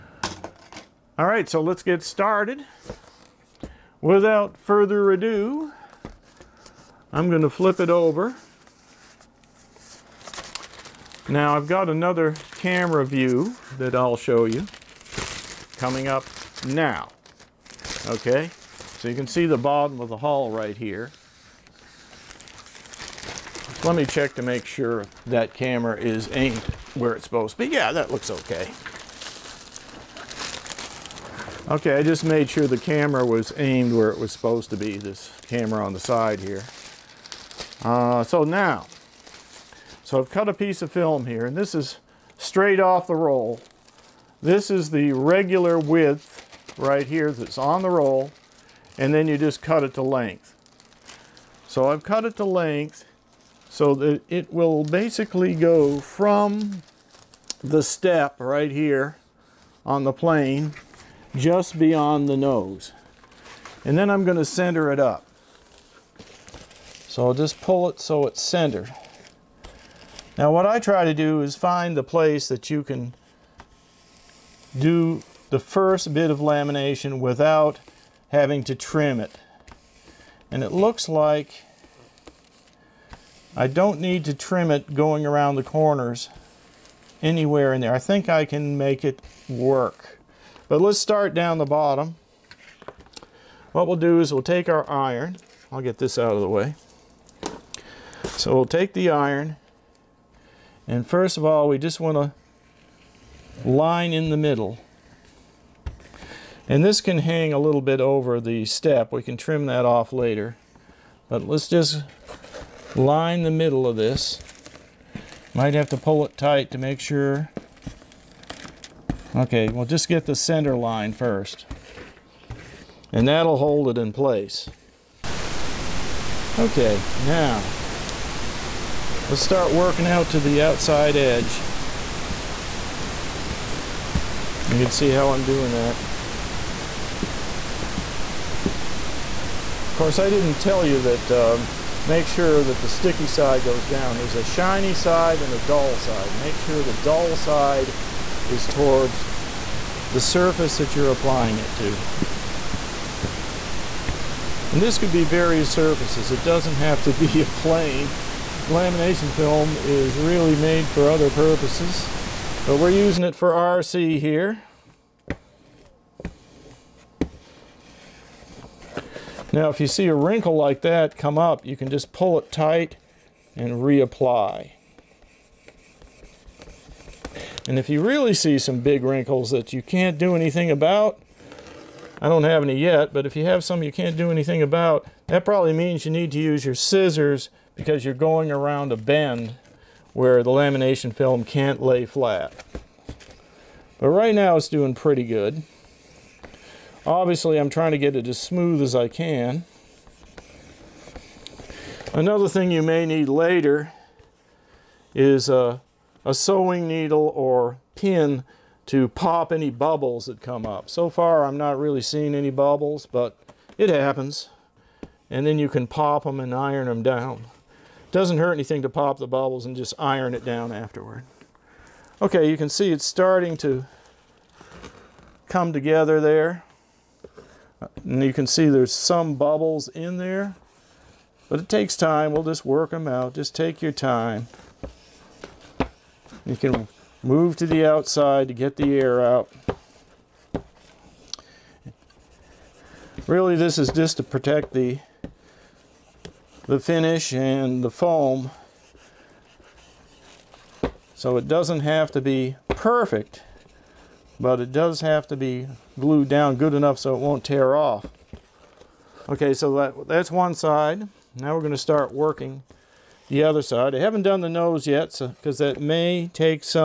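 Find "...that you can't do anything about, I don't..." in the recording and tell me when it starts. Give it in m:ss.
2:59.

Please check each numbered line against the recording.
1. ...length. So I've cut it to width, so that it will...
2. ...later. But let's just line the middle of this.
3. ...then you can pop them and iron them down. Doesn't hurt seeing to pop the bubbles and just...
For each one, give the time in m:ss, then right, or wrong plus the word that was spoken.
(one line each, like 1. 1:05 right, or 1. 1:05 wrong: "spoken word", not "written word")
1. 0:50 wrong: "length", not "width"
2. 1:50 right
3. 3:35 wrong: "anything", not "seeing".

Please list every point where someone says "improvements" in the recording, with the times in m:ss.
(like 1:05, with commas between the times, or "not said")
not said.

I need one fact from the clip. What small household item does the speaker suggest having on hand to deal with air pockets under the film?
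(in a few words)
A sewing needle.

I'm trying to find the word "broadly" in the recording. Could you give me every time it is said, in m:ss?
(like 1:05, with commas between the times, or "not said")
not said.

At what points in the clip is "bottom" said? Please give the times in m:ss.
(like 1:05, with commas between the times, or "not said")
0:19, 1:31.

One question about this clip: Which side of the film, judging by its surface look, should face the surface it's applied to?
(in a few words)
The dull side.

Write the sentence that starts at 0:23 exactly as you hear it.
Let me check to make sure that camera is aimed where it's supposed to be.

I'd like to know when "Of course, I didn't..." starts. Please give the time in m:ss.
2:18.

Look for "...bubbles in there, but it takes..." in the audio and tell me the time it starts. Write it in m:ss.
3:49.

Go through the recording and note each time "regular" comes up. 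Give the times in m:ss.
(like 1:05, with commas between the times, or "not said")
0:45.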